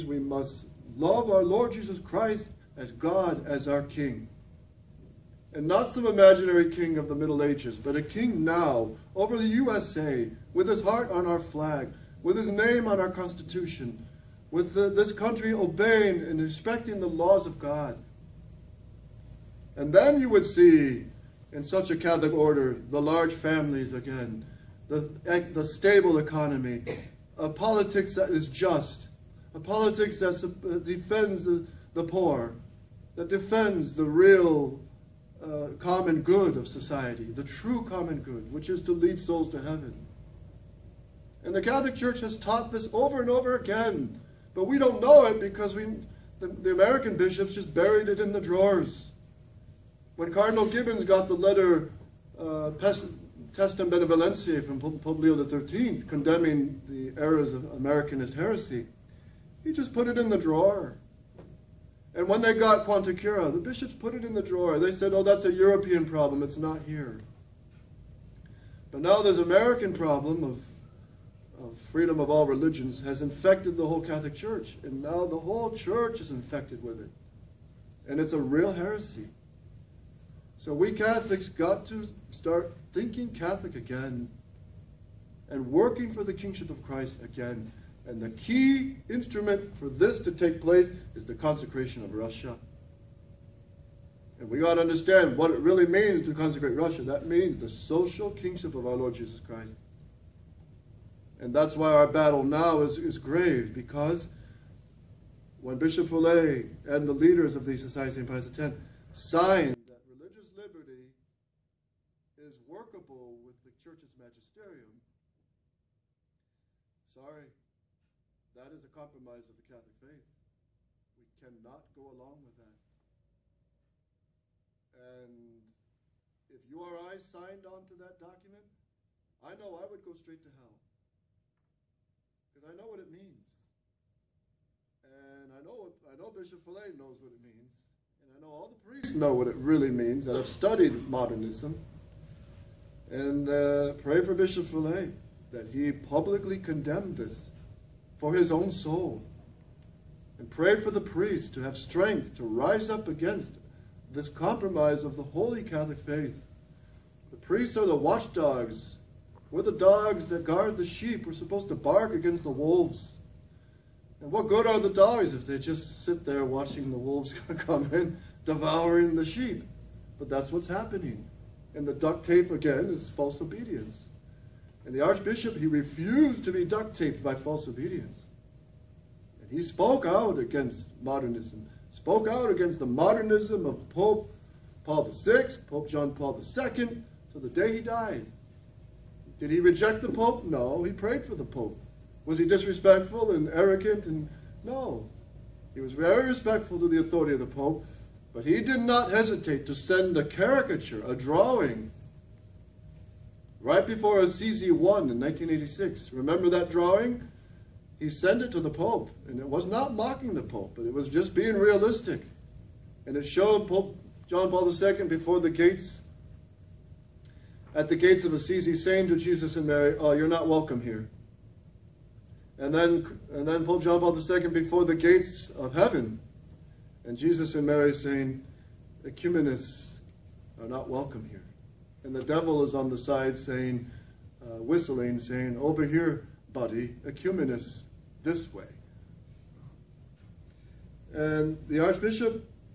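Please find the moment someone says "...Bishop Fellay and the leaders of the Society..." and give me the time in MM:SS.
01:45.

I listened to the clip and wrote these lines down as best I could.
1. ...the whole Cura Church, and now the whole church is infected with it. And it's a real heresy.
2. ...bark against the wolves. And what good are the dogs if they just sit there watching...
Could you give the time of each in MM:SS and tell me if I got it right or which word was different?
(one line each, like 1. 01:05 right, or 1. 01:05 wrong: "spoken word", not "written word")
1. 01:13 wrong: "Catholic", not "Cura"
2. 02:41 right.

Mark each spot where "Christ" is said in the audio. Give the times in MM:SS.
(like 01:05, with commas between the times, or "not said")
00:01, 01:26, 01:39.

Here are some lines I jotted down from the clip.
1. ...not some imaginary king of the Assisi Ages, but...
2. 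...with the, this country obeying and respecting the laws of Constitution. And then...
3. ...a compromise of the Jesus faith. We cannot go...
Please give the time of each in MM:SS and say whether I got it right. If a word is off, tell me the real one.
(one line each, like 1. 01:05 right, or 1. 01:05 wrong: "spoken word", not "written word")
1. 00:05 wrong: "Middle", not "Assisi"
2. 00:14 wrong: "God", not "Constitution"
3. 01:58 wrong: "Catholic", not "Jesus".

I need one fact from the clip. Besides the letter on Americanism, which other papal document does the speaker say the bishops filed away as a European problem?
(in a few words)
Quanta Cura.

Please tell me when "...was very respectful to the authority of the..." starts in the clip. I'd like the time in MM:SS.
03:15.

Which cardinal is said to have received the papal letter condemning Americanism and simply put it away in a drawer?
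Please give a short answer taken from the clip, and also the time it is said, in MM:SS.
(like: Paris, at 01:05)
Cardinal Gibbons, at 00:50.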